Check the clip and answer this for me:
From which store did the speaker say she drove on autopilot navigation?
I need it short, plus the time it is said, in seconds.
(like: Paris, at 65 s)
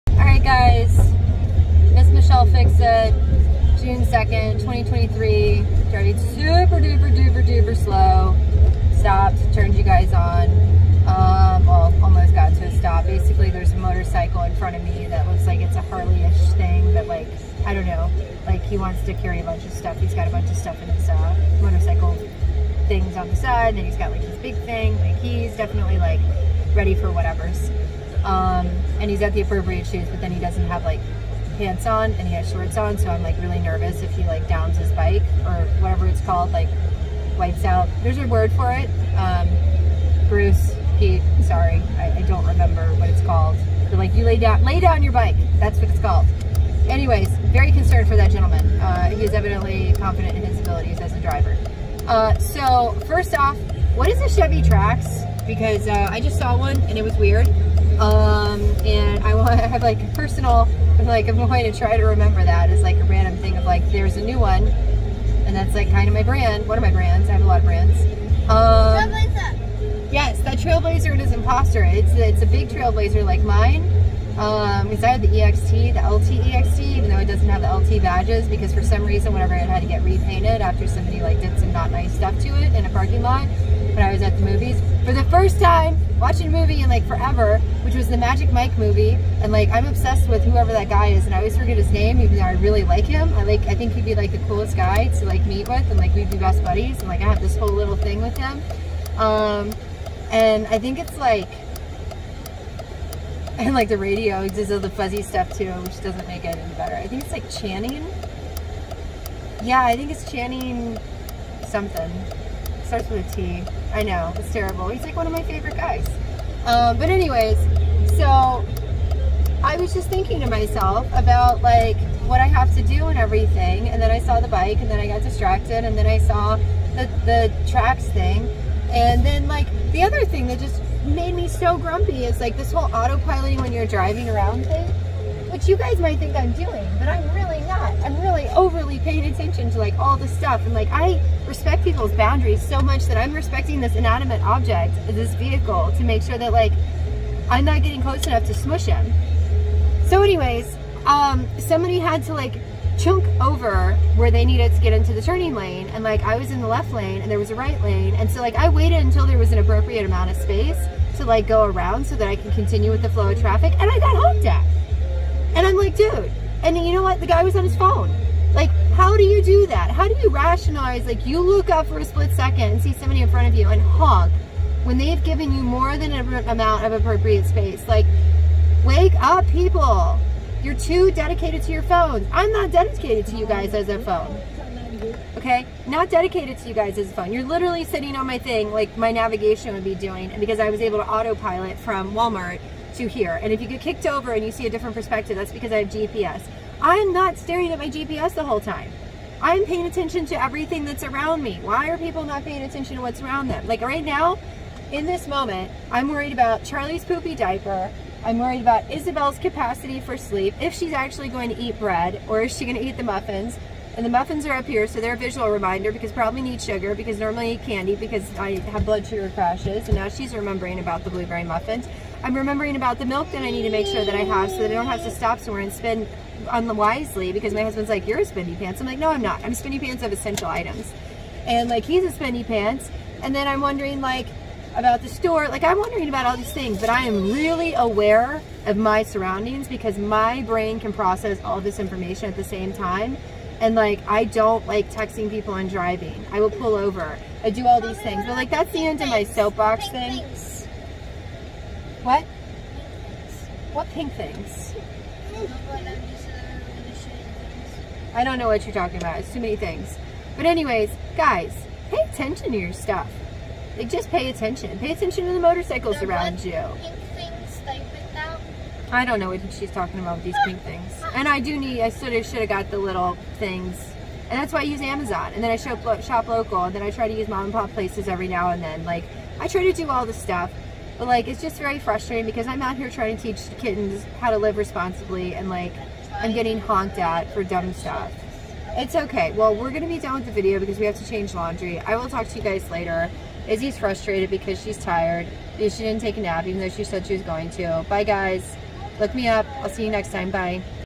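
Walmart, at 192 s.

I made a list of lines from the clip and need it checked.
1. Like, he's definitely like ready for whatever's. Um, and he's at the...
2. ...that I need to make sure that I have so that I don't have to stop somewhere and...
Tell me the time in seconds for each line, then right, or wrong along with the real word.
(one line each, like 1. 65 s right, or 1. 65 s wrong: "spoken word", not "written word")
1. 24 s right
2. 223 s right.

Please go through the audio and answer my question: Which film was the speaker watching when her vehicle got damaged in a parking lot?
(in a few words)
Magic Mike.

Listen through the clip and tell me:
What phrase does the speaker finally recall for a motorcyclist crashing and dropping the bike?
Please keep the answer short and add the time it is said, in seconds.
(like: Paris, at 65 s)
Lay down your bike, at 44 s.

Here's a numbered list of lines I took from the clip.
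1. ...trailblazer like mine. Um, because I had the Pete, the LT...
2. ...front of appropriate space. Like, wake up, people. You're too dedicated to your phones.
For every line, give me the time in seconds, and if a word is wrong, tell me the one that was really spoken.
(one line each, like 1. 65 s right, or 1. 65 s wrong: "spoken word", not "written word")
1. 72 s wrong: "EXT", not "Pete"
2. 176 s wrong: "amount", not "front".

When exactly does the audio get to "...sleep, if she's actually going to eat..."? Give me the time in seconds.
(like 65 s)
210 s.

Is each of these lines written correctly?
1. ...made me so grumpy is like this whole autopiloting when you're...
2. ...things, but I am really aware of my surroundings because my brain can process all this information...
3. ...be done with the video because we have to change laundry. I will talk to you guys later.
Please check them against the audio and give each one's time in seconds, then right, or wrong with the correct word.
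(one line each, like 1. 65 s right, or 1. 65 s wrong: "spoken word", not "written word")
1. 131 s right
2. 236 s right
3. 289 s right.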